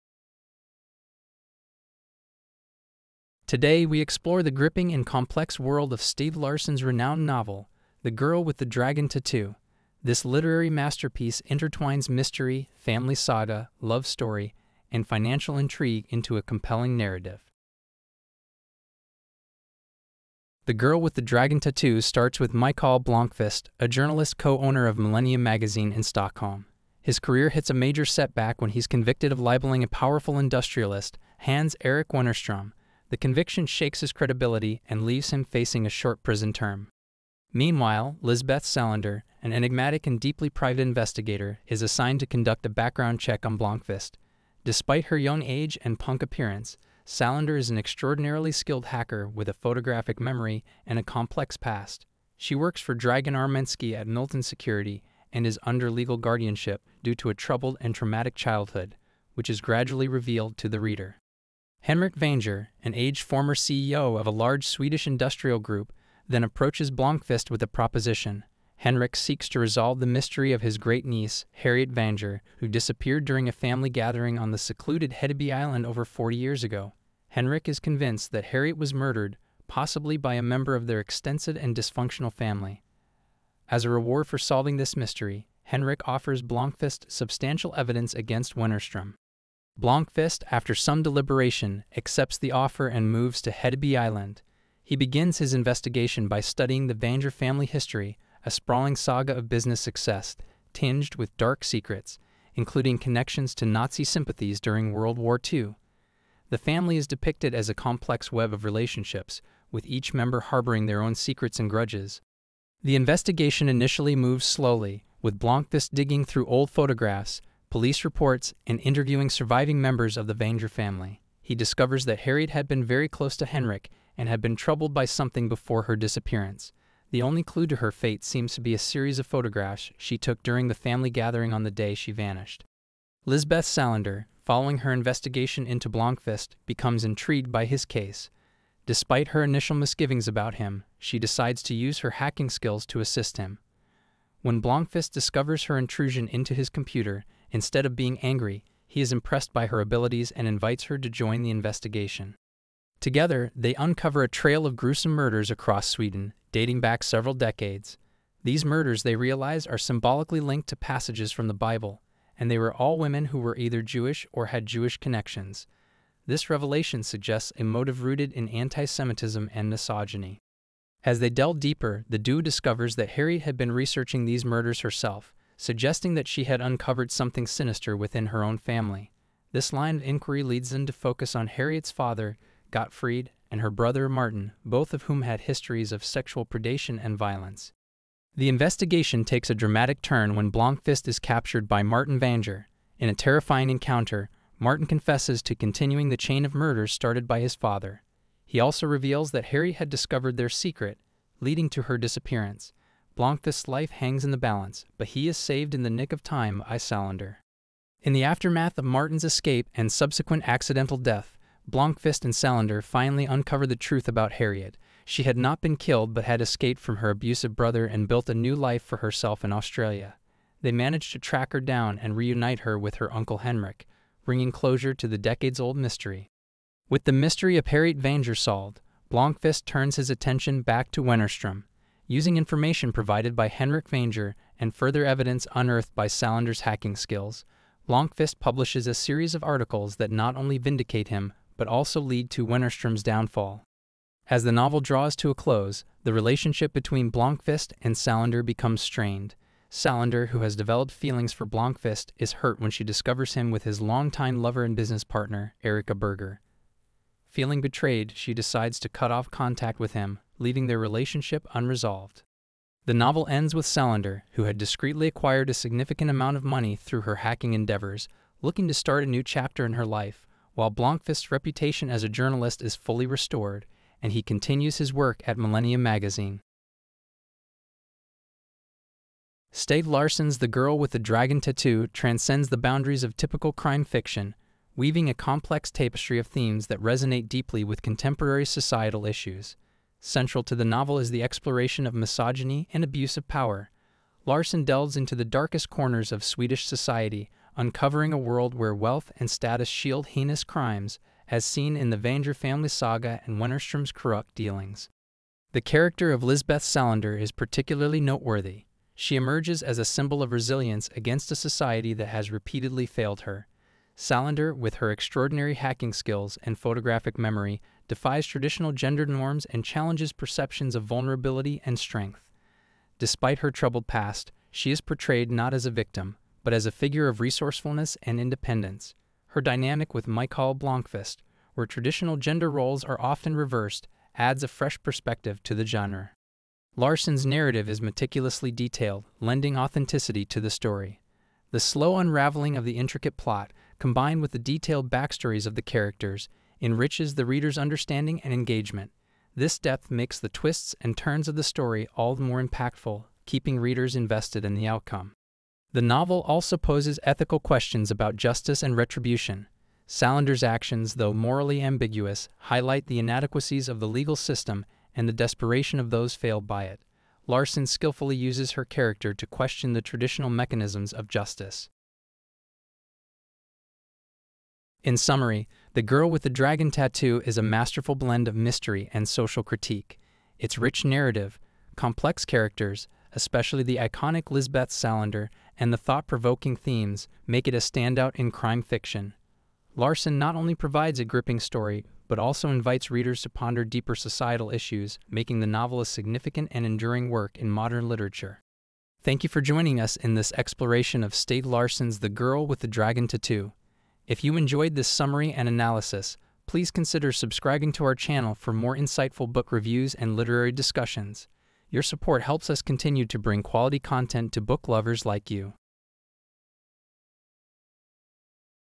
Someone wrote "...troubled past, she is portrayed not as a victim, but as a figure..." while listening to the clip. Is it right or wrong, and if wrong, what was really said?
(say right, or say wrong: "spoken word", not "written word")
right.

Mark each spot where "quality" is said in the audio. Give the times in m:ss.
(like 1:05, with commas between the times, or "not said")
6:53.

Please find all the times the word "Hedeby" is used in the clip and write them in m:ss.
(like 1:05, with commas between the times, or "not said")
1:15, 1:33.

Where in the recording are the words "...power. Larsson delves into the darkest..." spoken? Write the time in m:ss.
4:53.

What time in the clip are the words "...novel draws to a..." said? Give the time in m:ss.
4:04.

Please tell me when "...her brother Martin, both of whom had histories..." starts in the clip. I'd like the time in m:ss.
3:03.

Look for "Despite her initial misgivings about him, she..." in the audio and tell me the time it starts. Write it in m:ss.
2:18.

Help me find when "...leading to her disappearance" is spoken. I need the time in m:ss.
3:21.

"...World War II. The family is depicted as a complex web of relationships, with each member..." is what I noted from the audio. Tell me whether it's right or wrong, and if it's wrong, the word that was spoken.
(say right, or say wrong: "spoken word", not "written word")
right.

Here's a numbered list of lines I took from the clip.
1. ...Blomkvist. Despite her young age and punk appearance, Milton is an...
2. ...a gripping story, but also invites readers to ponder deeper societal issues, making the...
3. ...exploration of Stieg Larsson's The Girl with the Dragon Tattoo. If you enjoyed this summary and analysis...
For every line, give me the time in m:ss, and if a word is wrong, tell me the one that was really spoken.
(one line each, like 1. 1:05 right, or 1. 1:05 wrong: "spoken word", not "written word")
1. 0:43 wrong: "Salander", not "Milton"
2. 6:30 right
3. 6:40 right.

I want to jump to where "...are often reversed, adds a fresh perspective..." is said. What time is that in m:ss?
5:32.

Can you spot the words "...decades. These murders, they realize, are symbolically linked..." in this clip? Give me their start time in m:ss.
2:37.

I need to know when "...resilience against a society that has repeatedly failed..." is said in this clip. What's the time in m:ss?
5:10.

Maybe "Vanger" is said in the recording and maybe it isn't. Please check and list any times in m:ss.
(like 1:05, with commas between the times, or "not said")
1:02, 1:11, 1:36, 2:00, 3:12, 3:47, 3:53, 5:01.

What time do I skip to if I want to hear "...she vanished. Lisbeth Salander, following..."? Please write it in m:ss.
2:11.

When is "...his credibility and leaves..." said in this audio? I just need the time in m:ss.
0:33.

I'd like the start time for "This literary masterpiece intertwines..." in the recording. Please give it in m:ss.
0:10.